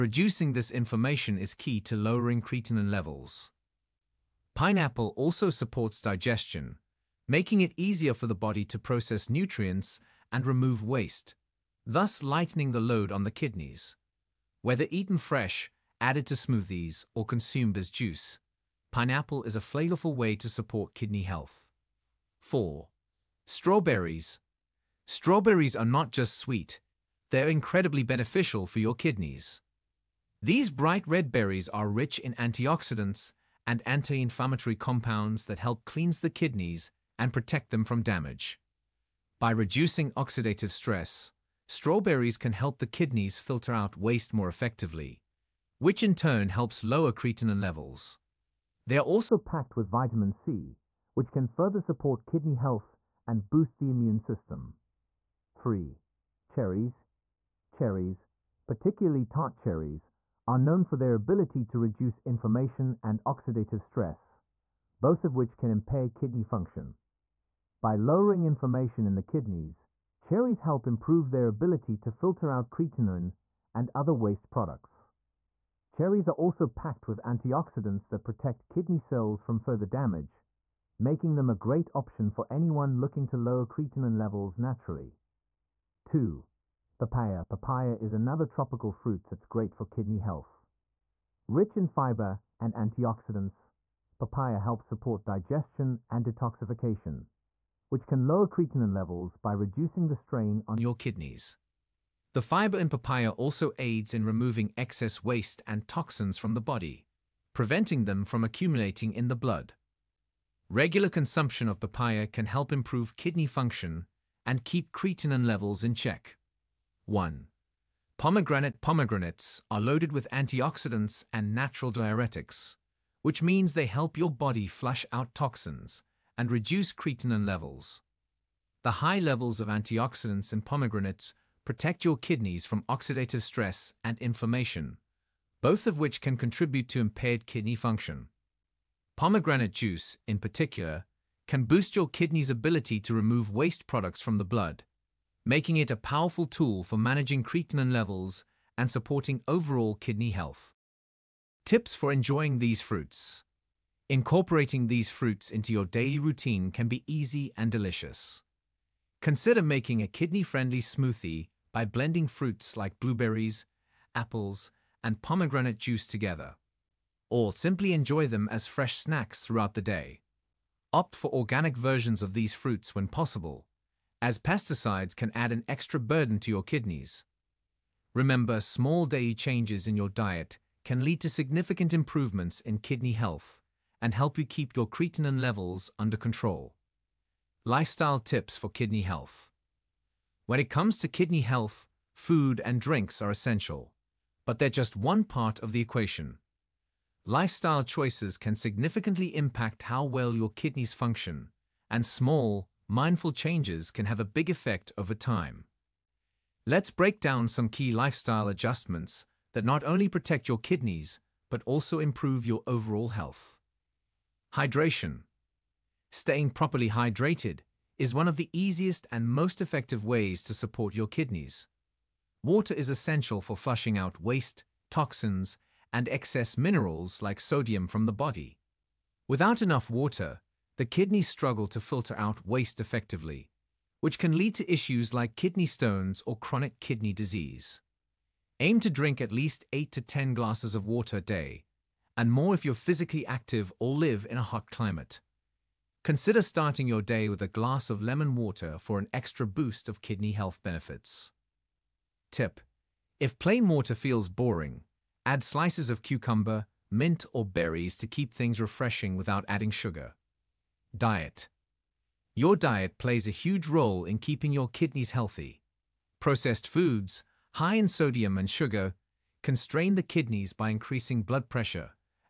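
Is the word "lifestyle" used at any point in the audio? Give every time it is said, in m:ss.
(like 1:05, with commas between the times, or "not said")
3:07, 3:17, 3:27.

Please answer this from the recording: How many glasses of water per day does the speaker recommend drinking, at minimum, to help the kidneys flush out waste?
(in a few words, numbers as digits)
8 to 10.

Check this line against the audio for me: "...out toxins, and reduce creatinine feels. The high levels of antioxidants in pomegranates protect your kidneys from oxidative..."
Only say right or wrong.
wrong.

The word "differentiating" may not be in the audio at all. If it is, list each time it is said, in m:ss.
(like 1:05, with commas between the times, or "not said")
not said.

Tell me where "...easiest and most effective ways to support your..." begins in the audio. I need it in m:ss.
3:38.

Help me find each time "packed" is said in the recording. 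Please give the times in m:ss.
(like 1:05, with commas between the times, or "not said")
0:49, 1:16.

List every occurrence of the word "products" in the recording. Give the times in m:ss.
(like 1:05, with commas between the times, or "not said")
1:14, 2:23.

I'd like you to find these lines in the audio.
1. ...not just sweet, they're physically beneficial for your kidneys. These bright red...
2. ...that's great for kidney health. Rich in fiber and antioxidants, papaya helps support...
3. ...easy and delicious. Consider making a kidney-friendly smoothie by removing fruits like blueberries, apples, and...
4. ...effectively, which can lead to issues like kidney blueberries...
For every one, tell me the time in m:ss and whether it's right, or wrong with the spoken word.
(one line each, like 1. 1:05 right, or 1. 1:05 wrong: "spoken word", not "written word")
1. 0:25 wrong: "incredibly", not "physically"
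2. 1:29 right
3. 2:37 wrong: "blending", not "removing"
4. 3:52 wrong: "stones", not "blueberries".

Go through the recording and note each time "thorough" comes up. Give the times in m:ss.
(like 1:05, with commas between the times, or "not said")
not said.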